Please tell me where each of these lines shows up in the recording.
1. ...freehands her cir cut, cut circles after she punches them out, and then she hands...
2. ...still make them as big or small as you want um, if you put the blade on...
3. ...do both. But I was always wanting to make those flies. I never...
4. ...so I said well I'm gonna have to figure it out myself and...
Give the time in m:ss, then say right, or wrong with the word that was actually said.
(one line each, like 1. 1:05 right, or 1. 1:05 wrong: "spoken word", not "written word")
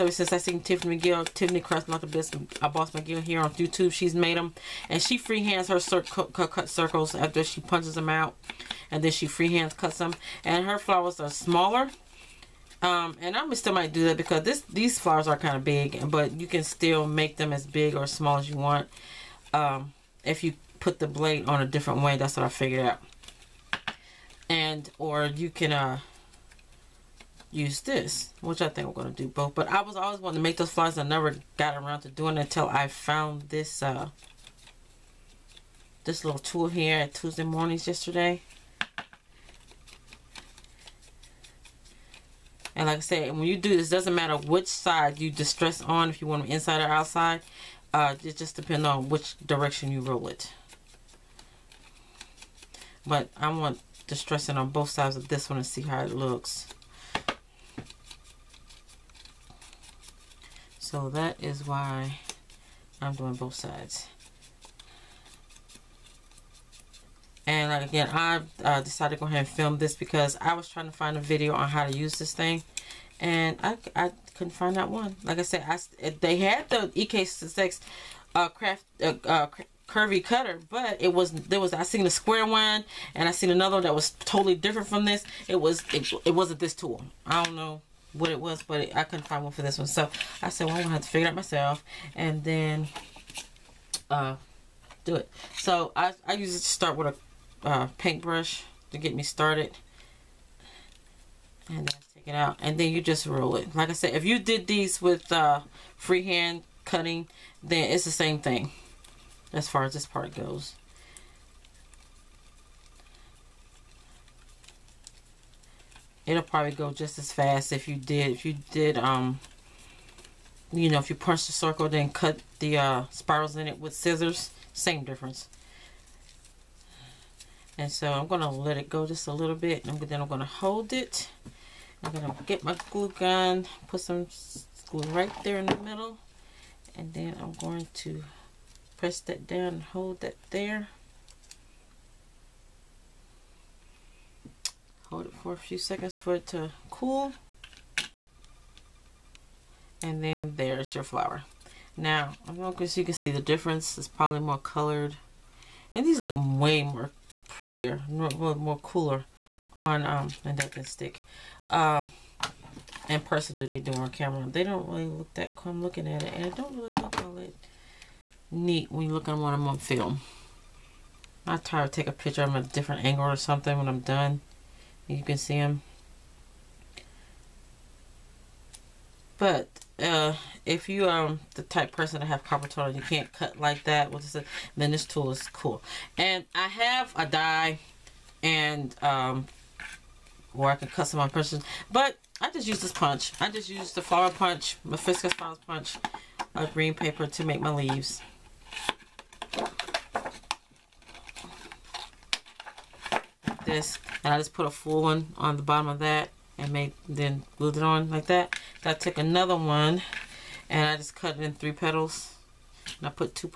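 1. 0:05 right
2. 0:16 right
3. 0:29 right
4. 1:29 right.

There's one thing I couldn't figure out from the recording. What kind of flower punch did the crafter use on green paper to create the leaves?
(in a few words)
hibiscus flower punch.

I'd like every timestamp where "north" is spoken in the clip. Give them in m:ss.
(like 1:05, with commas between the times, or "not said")
not said.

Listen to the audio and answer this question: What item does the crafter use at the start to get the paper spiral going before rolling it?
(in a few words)
paintbrush.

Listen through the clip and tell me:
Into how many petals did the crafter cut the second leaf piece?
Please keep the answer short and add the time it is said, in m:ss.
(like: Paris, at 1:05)
3, at 3:31.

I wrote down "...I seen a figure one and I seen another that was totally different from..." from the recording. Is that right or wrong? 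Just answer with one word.
wrong.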